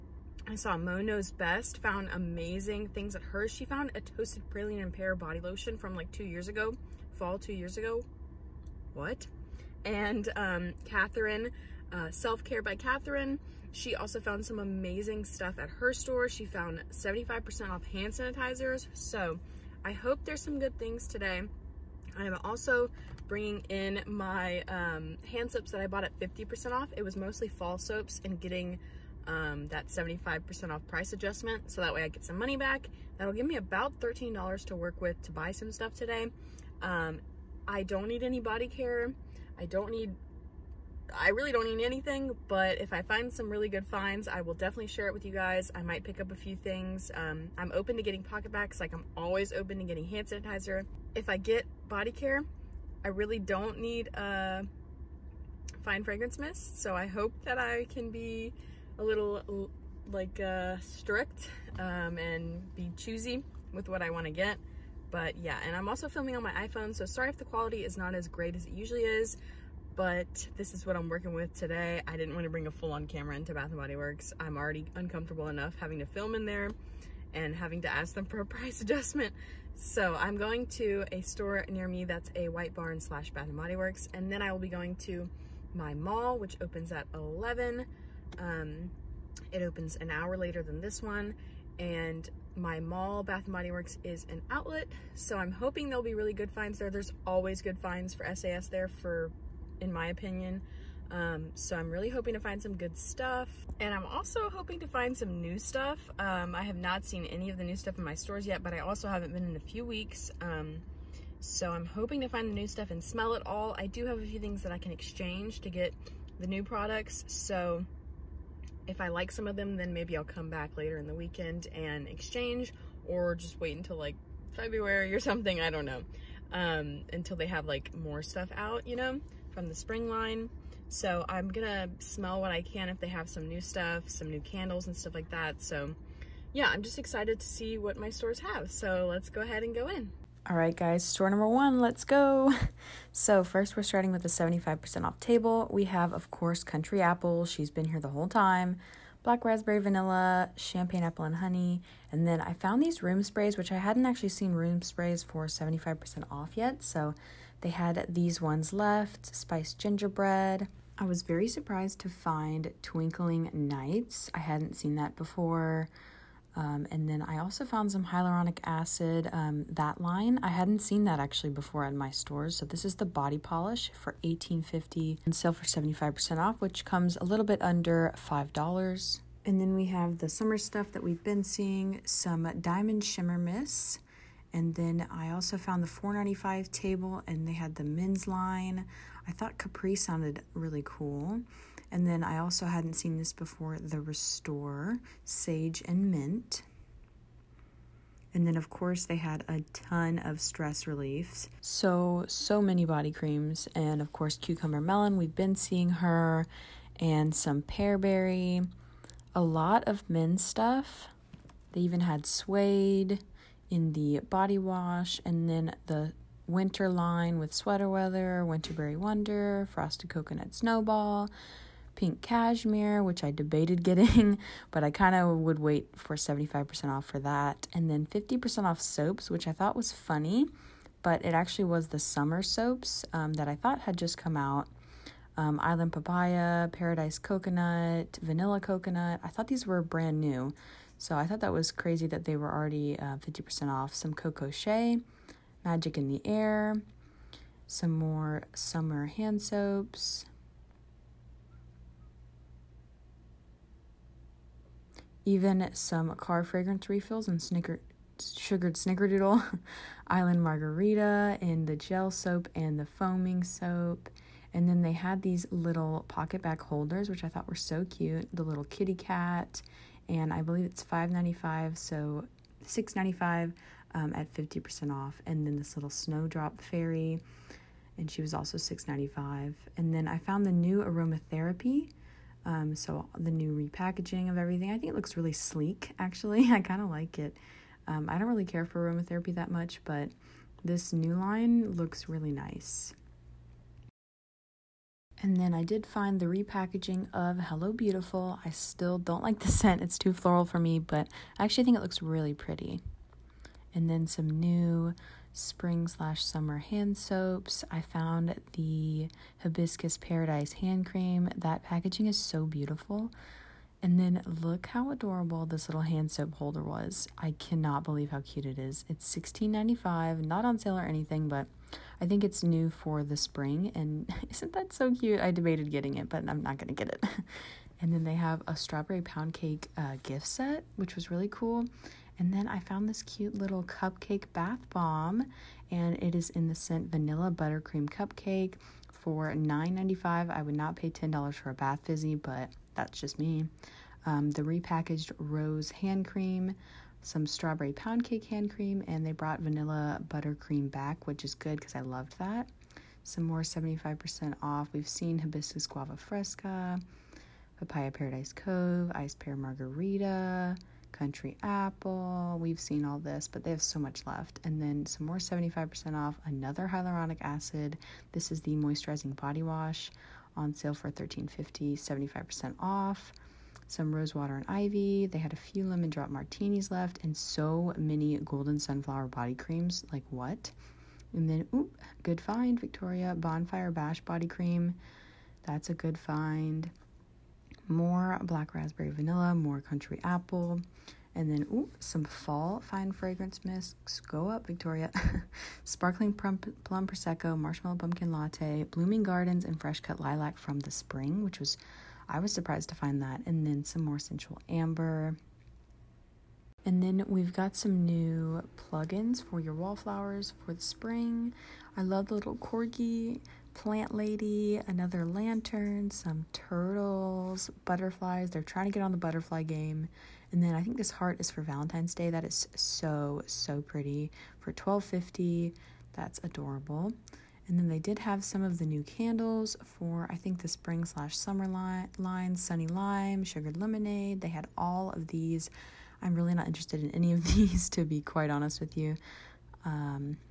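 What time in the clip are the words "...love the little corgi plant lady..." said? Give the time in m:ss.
6:51.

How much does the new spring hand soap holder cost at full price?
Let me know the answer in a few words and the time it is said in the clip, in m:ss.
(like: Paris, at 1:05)
$16.95, at 5:19.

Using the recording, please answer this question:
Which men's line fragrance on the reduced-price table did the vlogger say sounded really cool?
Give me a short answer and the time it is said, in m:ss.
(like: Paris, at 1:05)
Capri, at 3:09.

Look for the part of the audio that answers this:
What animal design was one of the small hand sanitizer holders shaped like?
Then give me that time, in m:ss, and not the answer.
4:28.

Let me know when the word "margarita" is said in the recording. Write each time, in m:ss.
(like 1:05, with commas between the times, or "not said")
4:20, 5:59.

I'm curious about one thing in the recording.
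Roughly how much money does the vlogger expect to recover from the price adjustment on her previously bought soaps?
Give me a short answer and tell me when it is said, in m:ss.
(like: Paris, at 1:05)
$13, at 0:33.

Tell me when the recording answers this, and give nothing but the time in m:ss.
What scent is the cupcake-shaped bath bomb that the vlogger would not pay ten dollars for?
5:36.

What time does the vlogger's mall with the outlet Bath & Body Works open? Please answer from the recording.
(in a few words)
11.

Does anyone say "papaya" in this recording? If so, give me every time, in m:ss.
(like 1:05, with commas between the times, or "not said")
3:55, 5:57.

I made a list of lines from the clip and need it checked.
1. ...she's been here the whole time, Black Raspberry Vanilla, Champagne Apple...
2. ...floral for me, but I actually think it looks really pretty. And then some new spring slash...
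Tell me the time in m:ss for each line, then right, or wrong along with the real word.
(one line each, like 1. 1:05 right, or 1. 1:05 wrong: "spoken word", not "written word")
1. 2:27 right
2. 5:00 right.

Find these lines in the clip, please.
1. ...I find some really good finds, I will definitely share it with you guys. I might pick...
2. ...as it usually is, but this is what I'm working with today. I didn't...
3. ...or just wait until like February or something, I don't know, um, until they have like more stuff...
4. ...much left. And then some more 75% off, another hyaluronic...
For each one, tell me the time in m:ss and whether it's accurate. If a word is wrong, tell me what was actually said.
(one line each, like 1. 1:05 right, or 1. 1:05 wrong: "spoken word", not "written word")
1. 0:42 right
2. 1:08 right
3. 2:03 right
4. 6:03 right.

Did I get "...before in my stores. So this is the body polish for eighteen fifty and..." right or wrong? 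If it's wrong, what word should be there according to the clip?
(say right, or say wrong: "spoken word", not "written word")
right.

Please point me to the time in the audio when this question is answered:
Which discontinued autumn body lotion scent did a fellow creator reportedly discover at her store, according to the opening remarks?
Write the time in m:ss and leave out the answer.
0:04.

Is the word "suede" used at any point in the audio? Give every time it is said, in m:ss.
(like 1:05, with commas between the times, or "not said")
3:32.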